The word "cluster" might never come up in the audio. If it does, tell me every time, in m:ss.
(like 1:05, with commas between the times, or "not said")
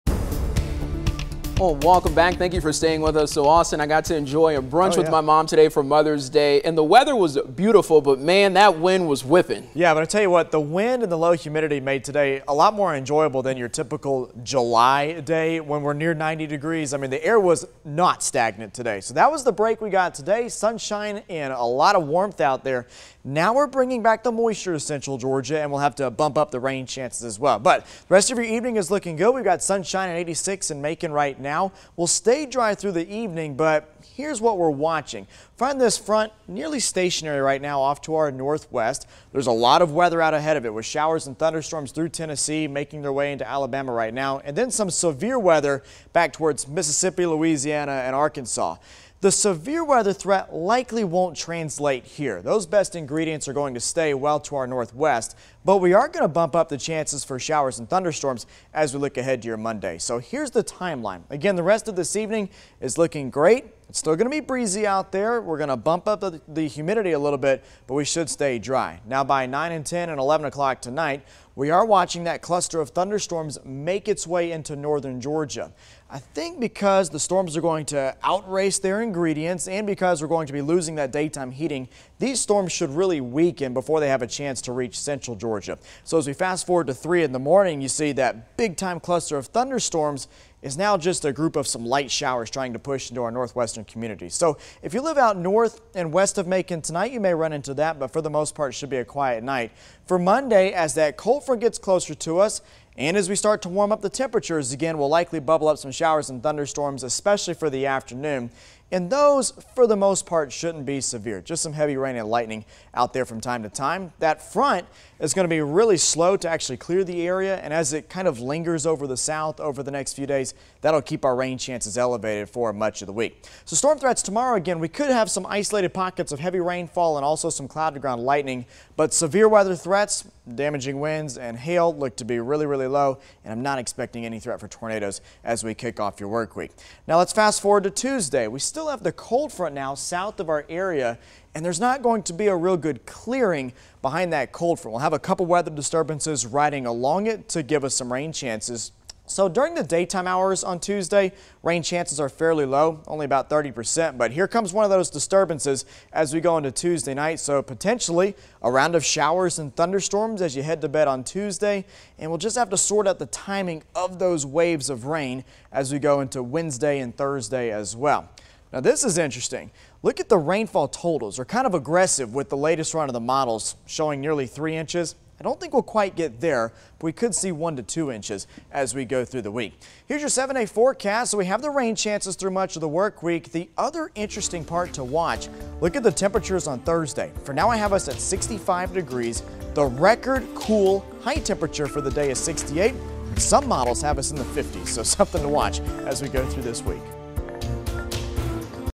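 1:12, 1:28.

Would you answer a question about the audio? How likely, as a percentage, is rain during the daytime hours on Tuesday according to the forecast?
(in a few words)
30%.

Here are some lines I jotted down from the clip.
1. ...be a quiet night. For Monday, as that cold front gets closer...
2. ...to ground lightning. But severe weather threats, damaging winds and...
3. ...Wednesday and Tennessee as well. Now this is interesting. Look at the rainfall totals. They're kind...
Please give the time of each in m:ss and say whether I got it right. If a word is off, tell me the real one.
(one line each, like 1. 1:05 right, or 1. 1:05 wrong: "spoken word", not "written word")
1. 1:38 right
2. 2:07 right
3. 2:46 wrong: "Thursday", not "Tennessee".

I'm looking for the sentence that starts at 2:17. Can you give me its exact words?
Now let's fast forward to Tuesday.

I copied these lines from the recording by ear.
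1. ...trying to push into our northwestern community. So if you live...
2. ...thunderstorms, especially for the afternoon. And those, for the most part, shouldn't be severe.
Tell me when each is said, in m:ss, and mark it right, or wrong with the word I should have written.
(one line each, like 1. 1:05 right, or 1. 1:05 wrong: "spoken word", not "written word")
1. 1:32 right
2. 1:46 right.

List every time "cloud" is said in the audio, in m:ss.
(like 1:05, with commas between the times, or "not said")
2:07.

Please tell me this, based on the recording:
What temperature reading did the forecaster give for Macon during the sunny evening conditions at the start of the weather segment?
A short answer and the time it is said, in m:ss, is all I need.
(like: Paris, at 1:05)
86, at 0:30.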